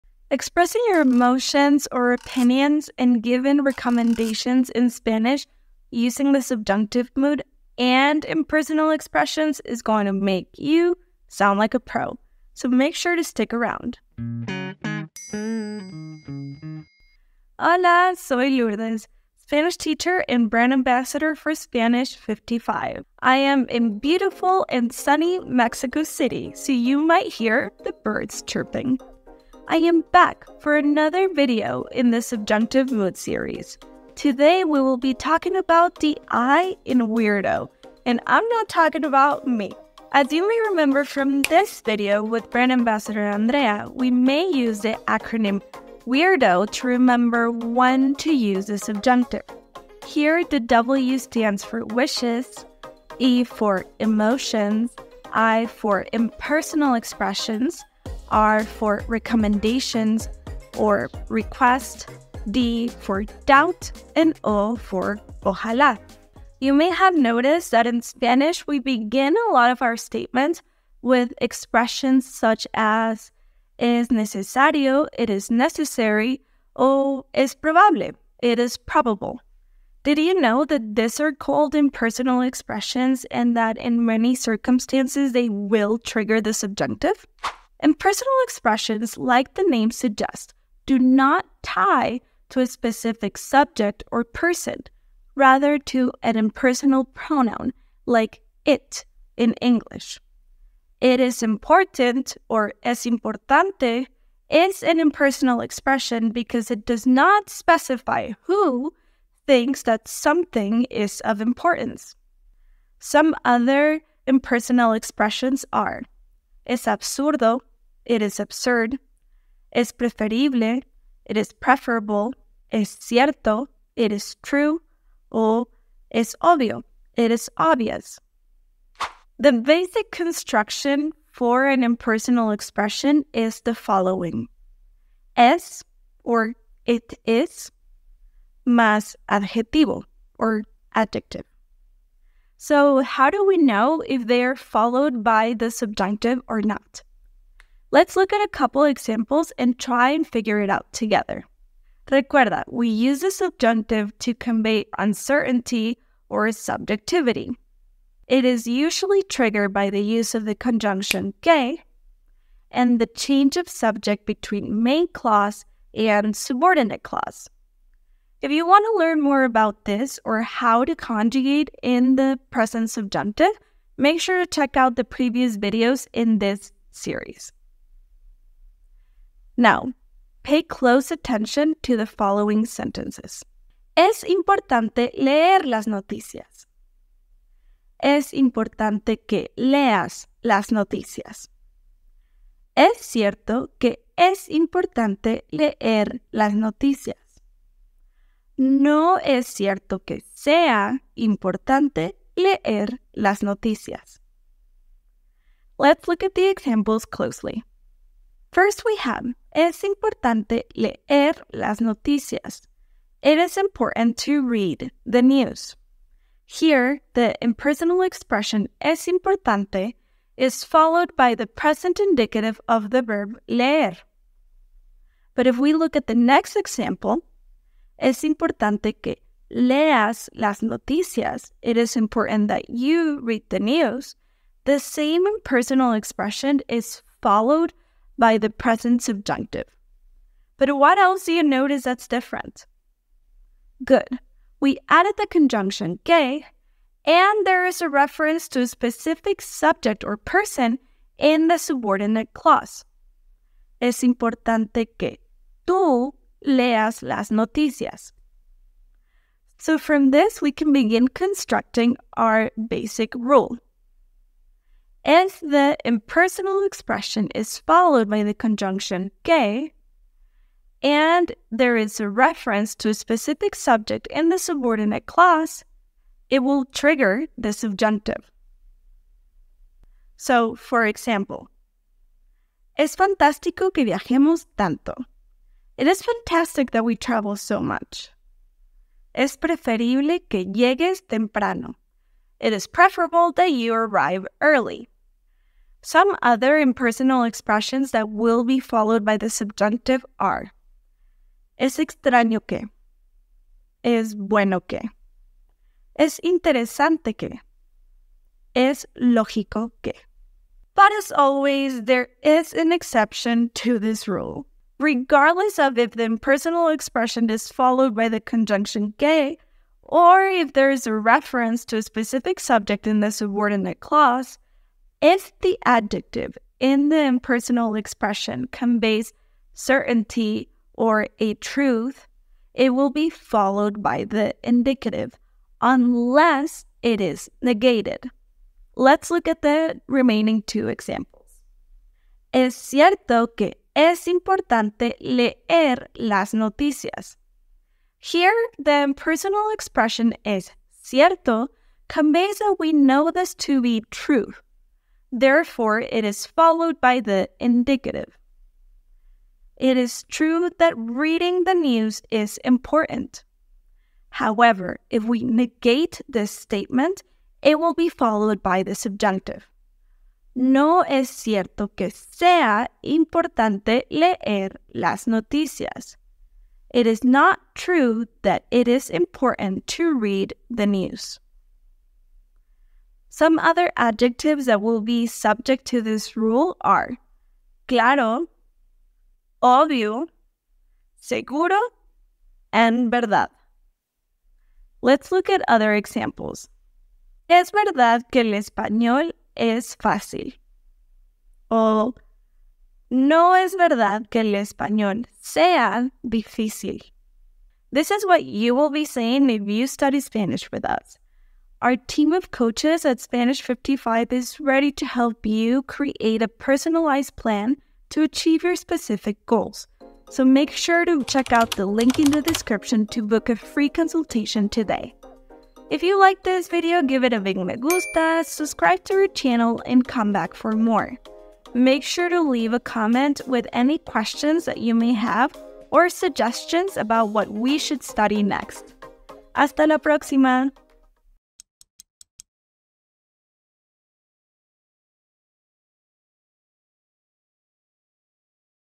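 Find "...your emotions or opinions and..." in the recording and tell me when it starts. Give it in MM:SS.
00:00.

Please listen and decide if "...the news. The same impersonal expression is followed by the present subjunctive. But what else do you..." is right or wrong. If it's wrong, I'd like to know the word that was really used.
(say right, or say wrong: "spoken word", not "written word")
right.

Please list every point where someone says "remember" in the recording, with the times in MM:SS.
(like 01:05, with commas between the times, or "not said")
00:40, 00:46.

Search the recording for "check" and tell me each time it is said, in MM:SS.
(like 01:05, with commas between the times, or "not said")
02:54, 07:01.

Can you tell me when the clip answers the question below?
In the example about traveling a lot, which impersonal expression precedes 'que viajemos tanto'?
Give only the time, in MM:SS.
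04:42.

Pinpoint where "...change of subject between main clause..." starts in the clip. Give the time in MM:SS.
02:43.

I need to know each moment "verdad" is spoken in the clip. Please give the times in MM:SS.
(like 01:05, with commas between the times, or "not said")
06:32, 06:37, 06:43.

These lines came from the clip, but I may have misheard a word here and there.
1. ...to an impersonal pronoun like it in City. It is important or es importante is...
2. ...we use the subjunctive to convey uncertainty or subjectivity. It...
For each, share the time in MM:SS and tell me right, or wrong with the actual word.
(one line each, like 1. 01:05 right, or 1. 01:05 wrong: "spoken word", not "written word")
1. 01:35 wrong: "English", not "City"
2. 02:32 right.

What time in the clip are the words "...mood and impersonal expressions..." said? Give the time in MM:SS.
00:07.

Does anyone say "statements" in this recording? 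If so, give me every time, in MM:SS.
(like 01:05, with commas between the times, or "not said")
01:09, 06:06.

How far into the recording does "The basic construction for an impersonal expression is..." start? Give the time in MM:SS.
02:09.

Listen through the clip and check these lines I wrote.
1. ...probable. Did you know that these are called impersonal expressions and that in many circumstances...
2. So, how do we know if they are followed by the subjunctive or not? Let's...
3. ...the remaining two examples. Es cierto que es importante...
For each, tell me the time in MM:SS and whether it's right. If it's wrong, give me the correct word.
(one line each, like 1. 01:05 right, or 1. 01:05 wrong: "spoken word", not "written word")
1. 01:18 right
2. 02:22 right
3. 05:39 right.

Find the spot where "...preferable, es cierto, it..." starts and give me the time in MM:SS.
02:01.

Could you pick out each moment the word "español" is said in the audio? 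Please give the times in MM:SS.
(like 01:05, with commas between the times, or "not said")
06:38, 06:44.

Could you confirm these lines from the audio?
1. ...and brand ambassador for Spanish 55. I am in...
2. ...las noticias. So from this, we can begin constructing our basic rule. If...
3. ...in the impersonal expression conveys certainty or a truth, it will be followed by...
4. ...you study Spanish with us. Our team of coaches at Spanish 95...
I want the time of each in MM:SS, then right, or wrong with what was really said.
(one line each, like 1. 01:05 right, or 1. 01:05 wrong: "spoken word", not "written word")
1. 00:20 right
2. 04:17 right
3. 05:26 right
4. 06:49 wrong: "55", not "95".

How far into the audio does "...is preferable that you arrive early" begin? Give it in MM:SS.
04:52.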